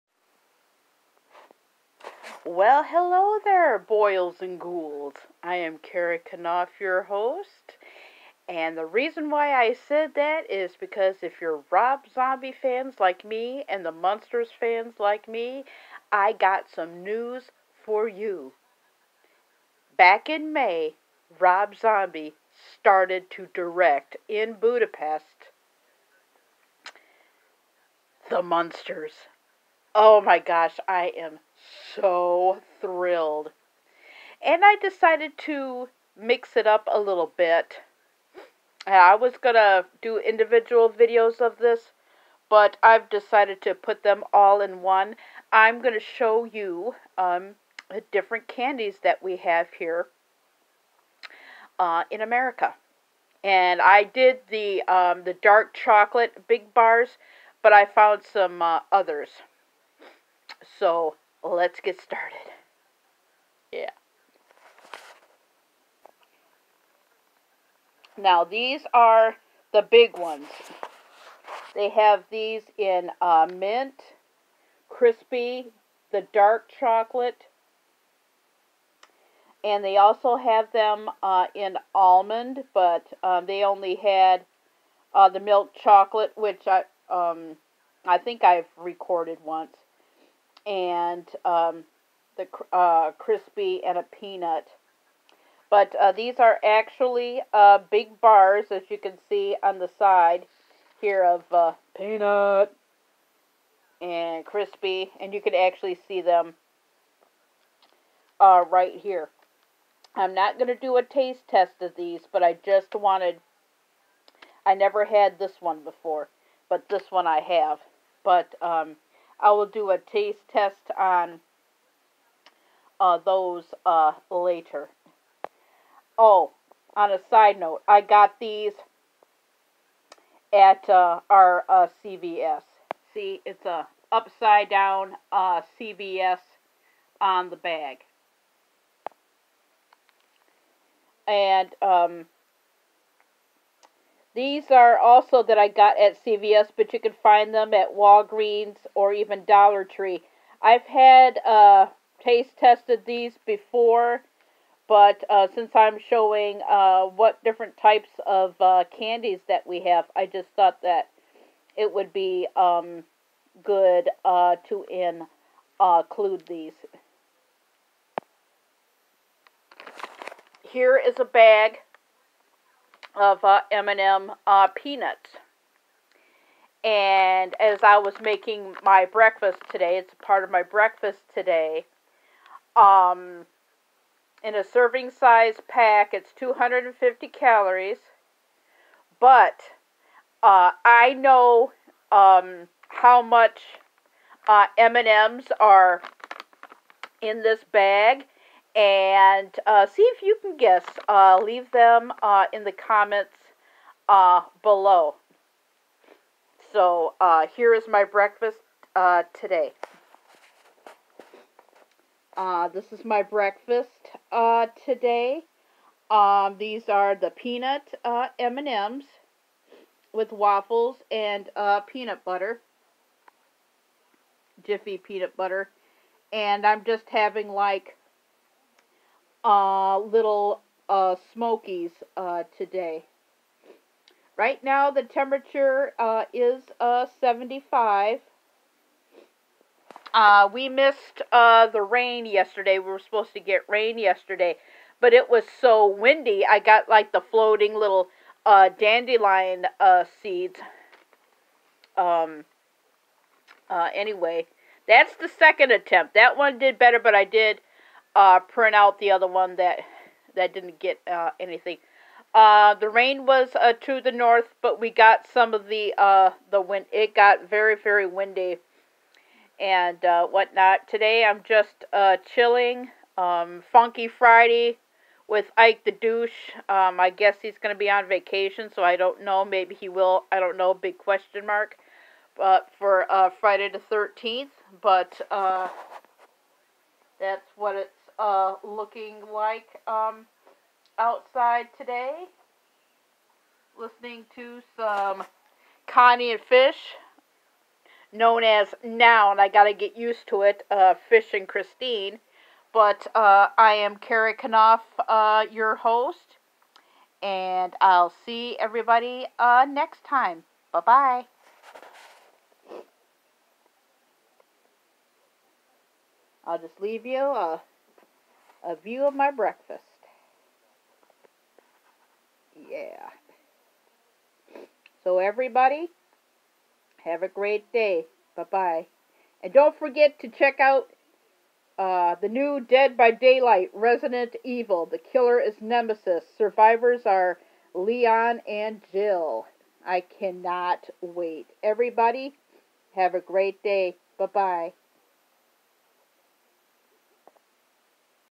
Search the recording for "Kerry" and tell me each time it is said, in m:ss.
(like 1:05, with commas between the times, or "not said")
0:05, 5:03.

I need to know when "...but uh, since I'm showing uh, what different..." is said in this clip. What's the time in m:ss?
2:34.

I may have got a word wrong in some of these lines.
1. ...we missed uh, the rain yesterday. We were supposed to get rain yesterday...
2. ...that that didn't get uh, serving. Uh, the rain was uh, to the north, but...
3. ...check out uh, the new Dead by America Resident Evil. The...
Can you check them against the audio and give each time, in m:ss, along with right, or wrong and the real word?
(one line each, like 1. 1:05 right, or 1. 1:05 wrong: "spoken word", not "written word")
1. 4:00 right
2. 4:19 wrong: "anything", not "serving"
3. 5:30 wrong: "Daylight", not "America".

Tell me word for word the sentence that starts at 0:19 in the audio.
Back in May, Rob Zombie started to direct in Budapest The Munsters.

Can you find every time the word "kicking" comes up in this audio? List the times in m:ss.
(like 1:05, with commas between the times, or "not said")
not said.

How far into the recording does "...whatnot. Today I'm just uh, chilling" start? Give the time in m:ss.
4:30.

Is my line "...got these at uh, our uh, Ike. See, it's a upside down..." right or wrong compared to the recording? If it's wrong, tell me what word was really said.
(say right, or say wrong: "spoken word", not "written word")
wrong: "CVS", not "Ike".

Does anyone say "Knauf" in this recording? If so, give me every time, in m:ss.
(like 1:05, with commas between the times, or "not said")
0:06, 5:04.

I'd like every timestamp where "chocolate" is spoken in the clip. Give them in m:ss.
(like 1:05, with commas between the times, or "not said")
0:55, 1:16, 1:25.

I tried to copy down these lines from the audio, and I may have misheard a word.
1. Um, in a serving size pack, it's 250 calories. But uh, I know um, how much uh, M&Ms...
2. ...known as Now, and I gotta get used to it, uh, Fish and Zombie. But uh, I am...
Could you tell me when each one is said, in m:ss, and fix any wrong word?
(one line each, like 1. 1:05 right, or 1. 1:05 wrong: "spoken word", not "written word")
1. 3:02 right
2. 4:58 wrong: "Christine", not "Zombie".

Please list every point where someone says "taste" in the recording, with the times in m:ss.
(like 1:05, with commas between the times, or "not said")
1:51, 1:59, 2:32.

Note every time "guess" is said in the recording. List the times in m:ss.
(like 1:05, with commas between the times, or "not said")
3:20, 4:37.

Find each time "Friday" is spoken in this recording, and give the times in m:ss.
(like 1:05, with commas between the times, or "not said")
4:34, 4:43.